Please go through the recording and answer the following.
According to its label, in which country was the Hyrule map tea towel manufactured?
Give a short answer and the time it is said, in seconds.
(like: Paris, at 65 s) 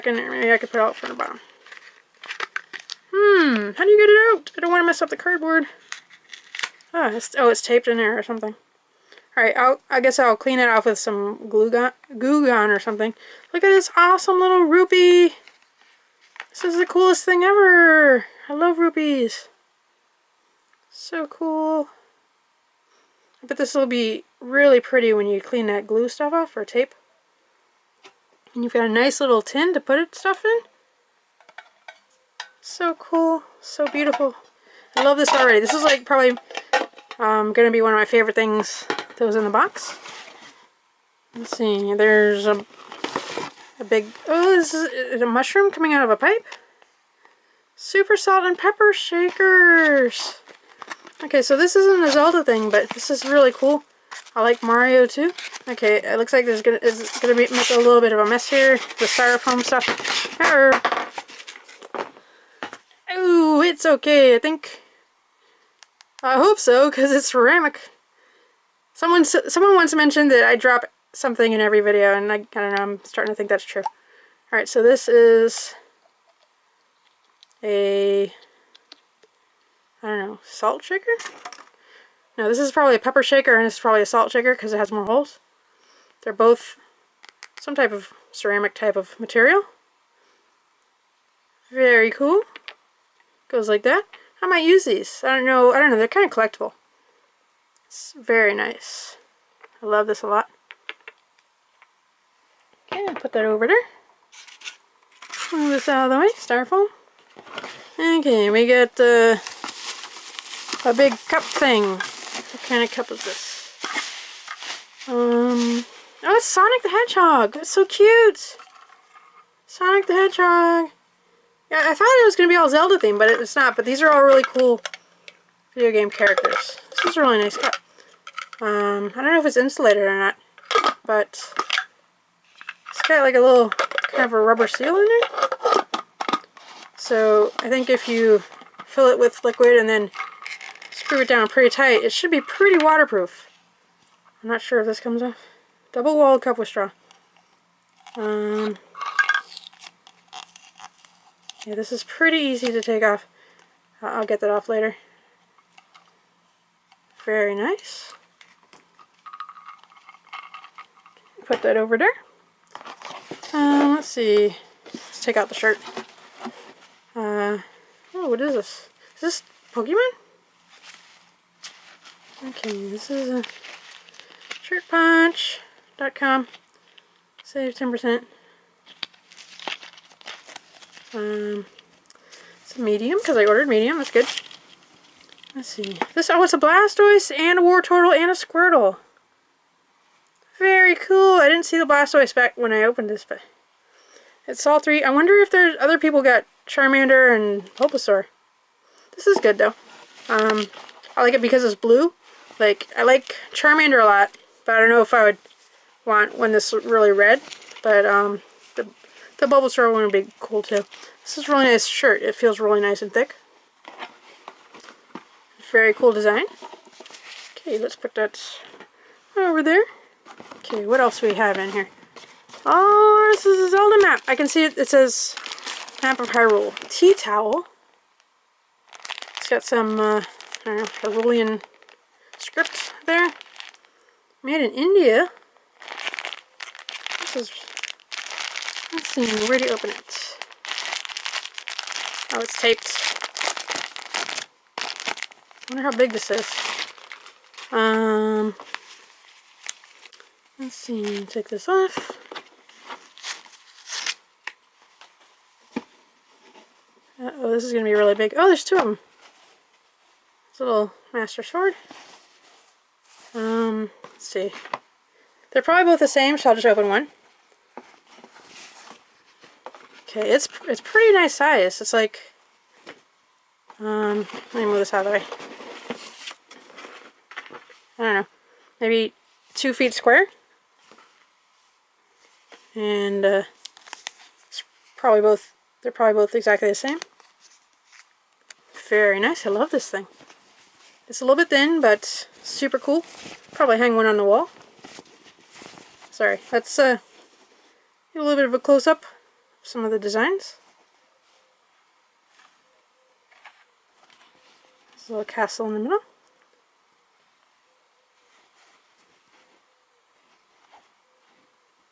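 India, at 234 s.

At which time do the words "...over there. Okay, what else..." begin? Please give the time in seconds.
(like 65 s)
219 s.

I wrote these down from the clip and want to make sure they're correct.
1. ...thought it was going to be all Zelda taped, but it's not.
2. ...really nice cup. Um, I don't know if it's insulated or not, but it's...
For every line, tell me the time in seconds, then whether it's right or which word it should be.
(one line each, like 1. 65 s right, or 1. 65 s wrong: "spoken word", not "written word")
1. 121 s wrong: "themed", not "taped"
2. 127 s right.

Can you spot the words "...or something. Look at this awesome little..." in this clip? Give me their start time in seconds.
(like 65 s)
12 s.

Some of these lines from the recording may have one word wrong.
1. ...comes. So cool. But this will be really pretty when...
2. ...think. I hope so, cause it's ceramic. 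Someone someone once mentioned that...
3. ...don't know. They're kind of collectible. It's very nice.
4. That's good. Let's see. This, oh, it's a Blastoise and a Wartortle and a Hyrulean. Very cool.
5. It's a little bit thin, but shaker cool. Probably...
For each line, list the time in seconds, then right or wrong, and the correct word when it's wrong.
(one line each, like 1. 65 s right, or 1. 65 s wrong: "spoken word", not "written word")
1. 18 s wrong: "rupees", not "comes"
2. 64 s right
3. 95 s right
4. 183 s wrong: "Squirtle", not "Hyrulean"
5. 291 s wrong: "super", not "shaker".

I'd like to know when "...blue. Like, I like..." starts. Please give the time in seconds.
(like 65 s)
201 s.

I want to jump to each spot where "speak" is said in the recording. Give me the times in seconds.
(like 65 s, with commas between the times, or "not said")
not said.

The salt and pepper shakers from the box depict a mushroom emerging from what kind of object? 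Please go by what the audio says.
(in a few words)
A pipe.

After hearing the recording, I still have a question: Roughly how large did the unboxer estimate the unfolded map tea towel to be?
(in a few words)
About 2 feet square.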